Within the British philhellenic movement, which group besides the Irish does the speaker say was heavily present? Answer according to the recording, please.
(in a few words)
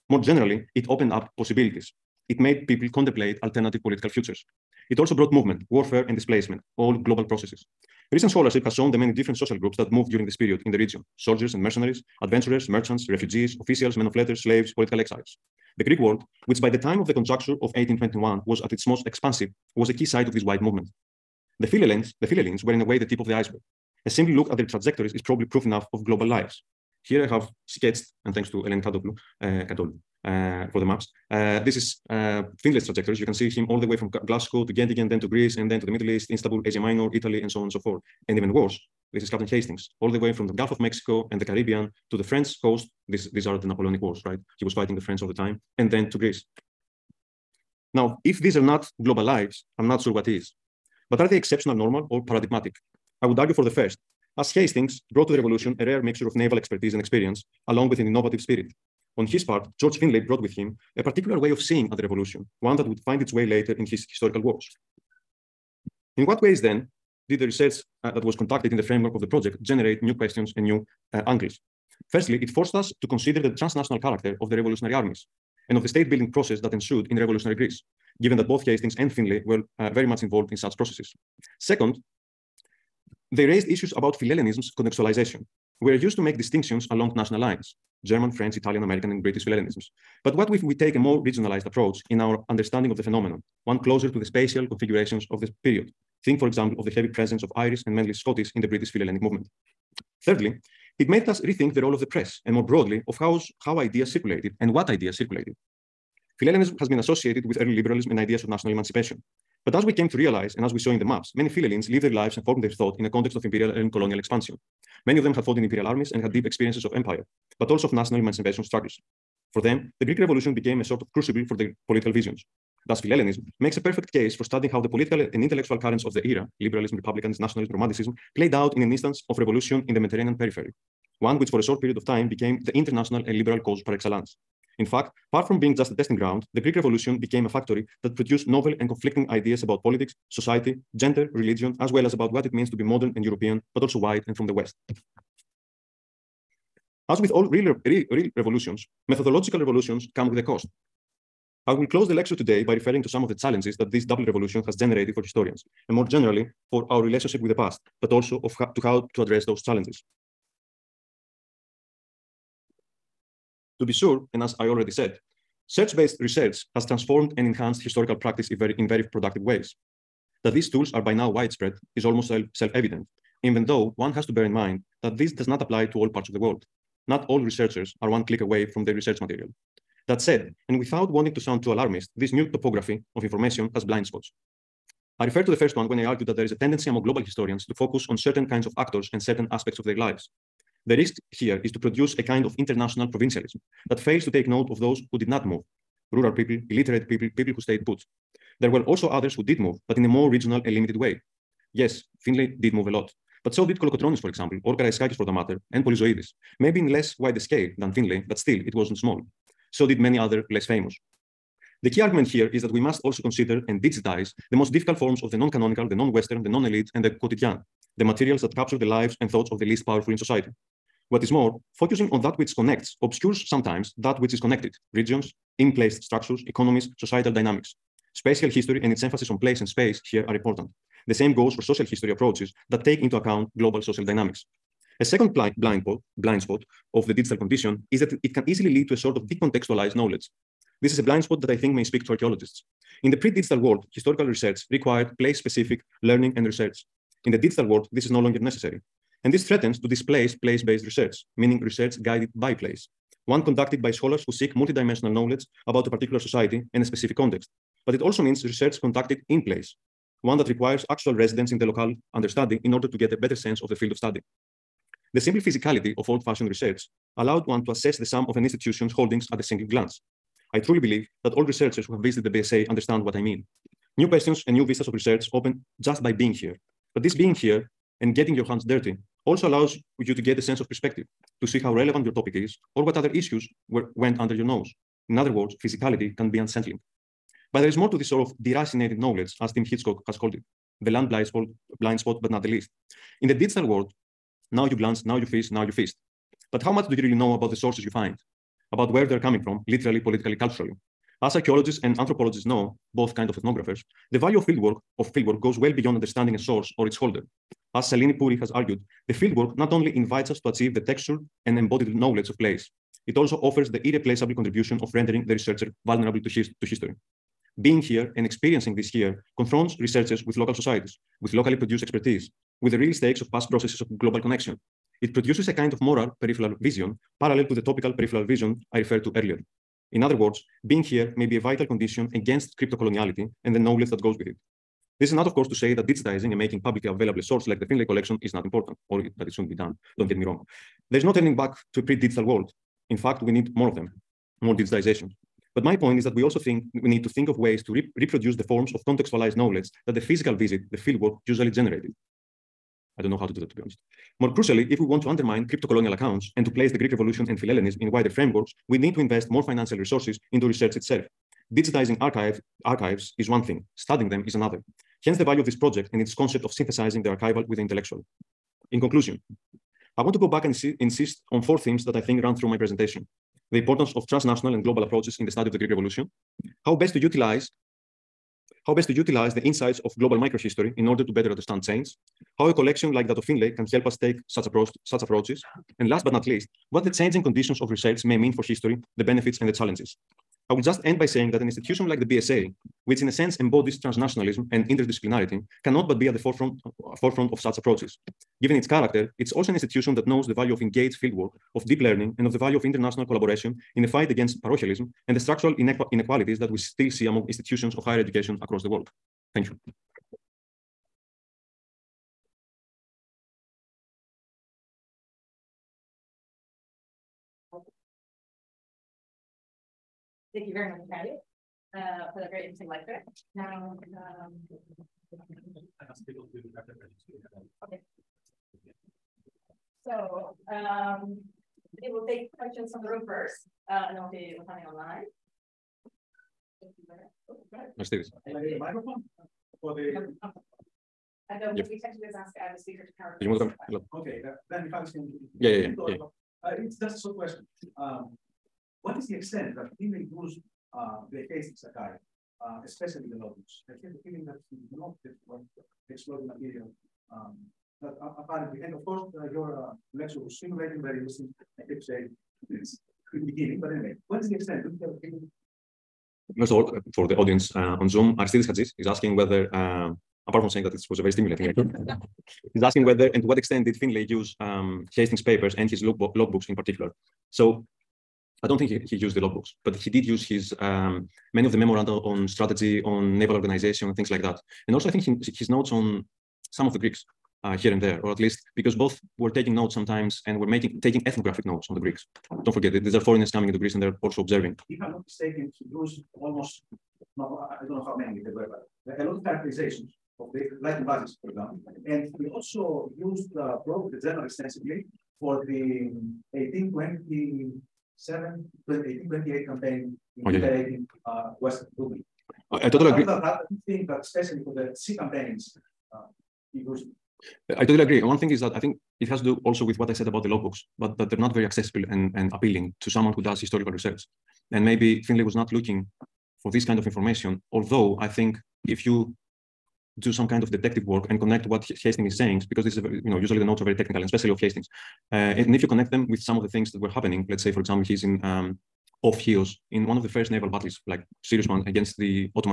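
Scottish.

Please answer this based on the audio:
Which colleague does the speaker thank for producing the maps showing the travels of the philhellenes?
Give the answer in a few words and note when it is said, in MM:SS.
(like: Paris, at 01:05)
Eleni Kadoglou, at 00:28.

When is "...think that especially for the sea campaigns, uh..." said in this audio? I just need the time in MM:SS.
08:33.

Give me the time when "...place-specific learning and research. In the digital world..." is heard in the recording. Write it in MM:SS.
04:05.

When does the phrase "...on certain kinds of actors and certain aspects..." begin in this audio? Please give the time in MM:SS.
03:08.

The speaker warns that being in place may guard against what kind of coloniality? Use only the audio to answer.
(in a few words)
crypto coloniality.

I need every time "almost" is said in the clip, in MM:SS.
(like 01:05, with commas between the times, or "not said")
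02:52, 08:16.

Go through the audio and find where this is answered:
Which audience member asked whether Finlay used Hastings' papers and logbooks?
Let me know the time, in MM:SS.
07:48.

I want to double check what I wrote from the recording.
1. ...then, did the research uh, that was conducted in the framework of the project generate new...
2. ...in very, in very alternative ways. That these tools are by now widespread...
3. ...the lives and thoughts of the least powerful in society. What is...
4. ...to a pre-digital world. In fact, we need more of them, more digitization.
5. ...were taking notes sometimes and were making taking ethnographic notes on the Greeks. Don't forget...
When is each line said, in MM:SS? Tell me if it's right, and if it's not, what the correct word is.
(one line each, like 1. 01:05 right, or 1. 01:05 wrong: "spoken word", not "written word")
1. 01:06 right
2. 02:48 wrong: "productive", not "alternative"
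3. 03:38 right
4. 05:41 right
5. 08:09 right.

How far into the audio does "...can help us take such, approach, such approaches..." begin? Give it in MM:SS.
06:23.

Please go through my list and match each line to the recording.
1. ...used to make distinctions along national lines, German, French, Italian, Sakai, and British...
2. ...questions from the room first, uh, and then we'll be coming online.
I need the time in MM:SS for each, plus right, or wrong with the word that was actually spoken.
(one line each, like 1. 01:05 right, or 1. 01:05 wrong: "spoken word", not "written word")
1. 01:26 wrong: "American", not "Sakai"
2. 07:12 right.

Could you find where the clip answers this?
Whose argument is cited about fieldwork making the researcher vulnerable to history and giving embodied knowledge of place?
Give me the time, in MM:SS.
05:07.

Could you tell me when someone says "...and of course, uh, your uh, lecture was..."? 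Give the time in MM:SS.
07:38.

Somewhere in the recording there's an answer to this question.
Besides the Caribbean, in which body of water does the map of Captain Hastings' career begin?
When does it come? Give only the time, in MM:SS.
00:40.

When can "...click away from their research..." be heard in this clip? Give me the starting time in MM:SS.
02:58.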